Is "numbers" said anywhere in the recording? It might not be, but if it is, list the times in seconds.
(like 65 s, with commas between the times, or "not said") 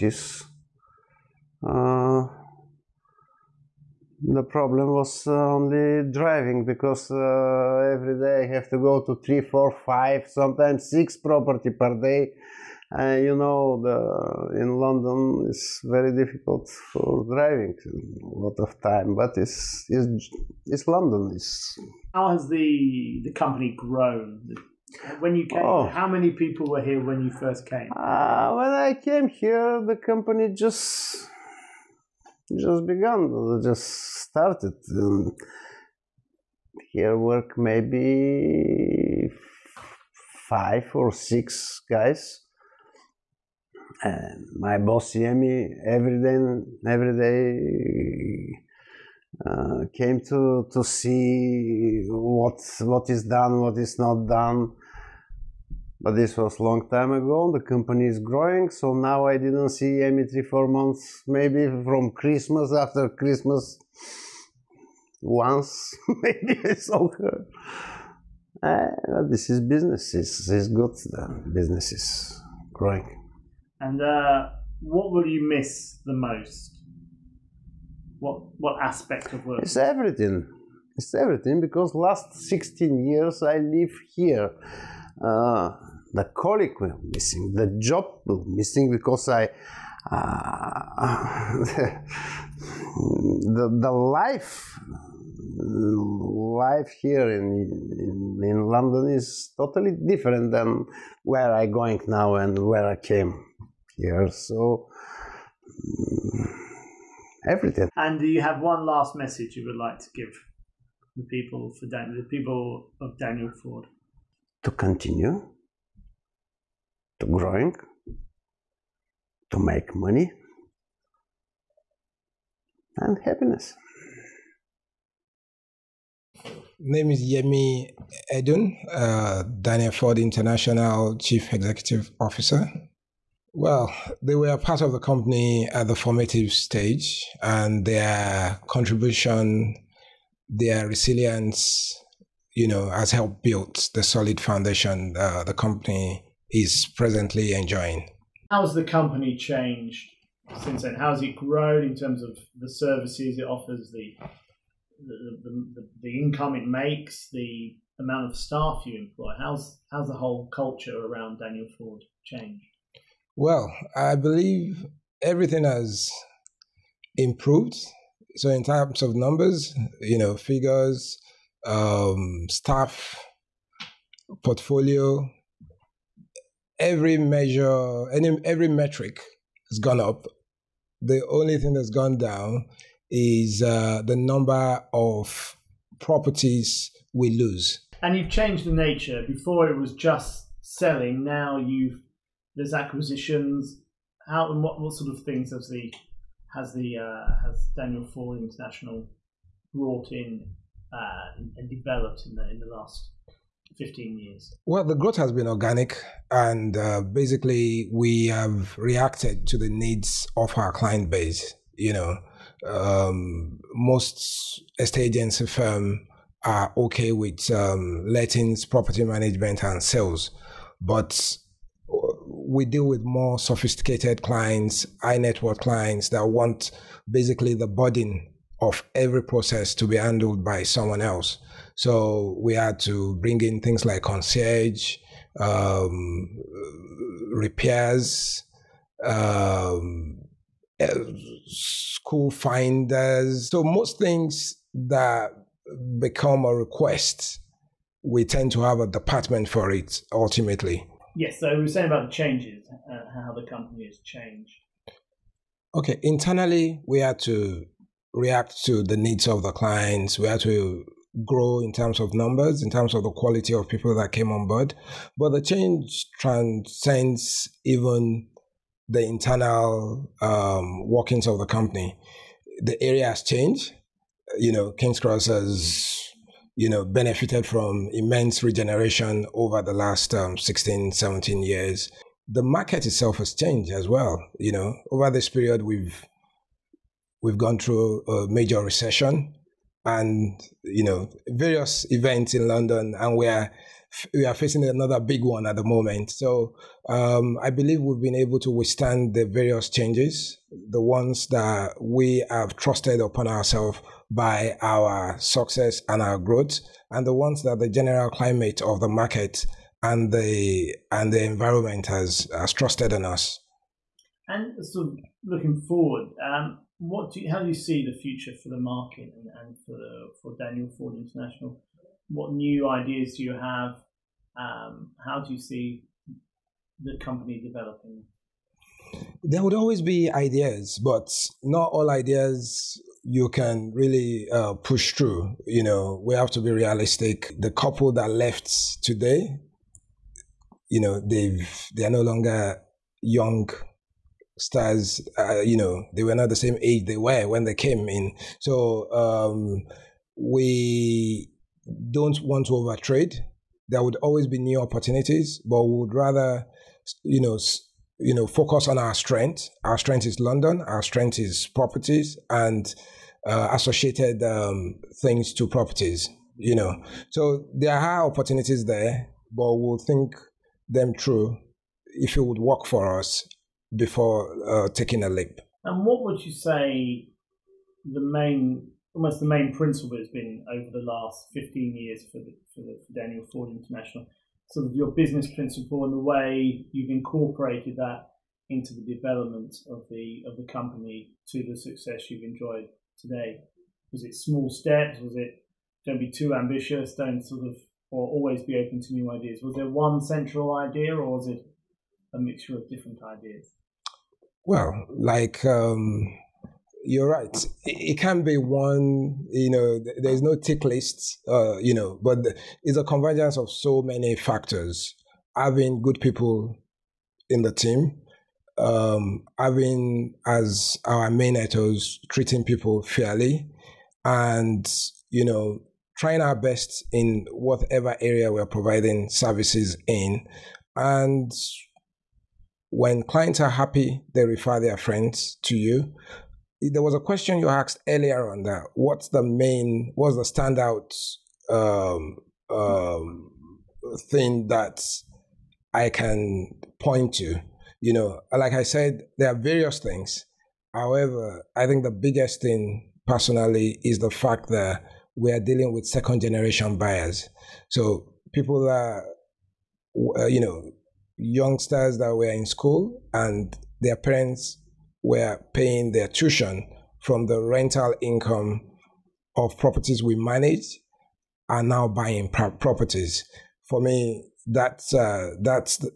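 169 s, 184 s, 262 s.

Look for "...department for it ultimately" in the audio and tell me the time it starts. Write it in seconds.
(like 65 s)
248 s.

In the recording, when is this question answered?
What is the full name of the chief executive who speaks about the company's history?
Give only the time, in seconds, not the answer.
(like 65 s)
127 s.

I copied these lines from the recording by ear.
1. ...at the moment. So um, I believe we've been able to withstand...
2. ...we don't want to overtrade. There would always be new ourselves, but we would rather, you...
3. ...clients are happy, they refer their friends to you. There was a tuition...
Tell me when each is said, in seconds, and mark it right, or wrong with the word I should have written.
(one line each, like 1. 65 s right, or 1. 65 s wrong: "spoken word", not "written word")
1. 295 s right
2. 350 s wrong: "opportunities", not "ourselves"
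3. 433 s wrong: "question", not "tuition".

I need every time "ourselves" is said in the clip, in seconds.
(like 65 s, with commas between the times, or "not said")
303 s.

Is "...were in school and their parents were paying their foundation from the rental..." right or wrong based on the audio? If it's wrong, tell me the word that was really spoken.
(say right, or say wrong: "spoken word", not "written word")
wrong: "tuition", not "foundation".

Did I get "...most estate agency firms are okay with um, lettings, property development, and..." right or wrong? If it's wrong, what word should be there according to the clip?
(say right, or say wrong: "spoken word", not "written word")
wrong: "management", not "development".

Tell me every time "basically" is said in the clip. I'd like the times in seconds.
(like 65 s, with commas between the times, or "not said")
207 s, 227 s.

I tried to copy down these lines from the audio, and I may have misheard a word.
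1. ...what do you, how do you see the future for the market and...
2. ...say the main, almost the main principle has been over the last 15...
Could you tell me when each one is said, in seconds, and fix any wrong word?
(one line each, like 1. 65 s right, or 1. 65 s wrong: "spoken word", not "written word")
1. 316 s right
2. 376 s right.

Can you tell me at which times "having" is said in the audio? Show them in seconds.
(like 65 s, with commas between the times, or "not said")
415 s, 419 s.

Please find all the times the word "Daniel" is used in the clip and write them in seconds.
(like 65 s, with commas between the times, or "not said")
113 s, 129 s, 161 s, 197 s, 320 s, 382 s.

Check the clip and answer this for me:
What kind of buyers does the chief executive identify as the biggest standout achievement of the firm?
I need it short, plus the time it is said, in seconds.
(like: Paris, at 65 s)
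second generation buyers, at 455 s.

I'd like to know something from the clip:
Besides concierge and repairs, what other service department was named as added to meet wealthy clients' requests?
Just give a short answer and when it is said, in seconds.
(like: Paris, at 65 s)
school finders, at 241 s.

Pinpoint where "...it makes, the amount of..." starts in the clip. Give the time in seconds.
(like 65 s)
156 s.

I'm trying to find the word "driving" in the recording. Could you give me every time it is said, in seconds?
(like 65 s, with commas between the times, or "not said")
6 s, 17 s.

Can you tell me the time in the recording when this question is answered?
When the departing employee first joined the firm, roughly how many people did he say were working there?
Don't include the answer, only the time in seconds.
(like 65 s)
40 s.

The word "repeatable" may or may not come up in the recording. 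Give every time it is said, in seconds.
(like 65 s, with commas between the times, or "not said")
not said.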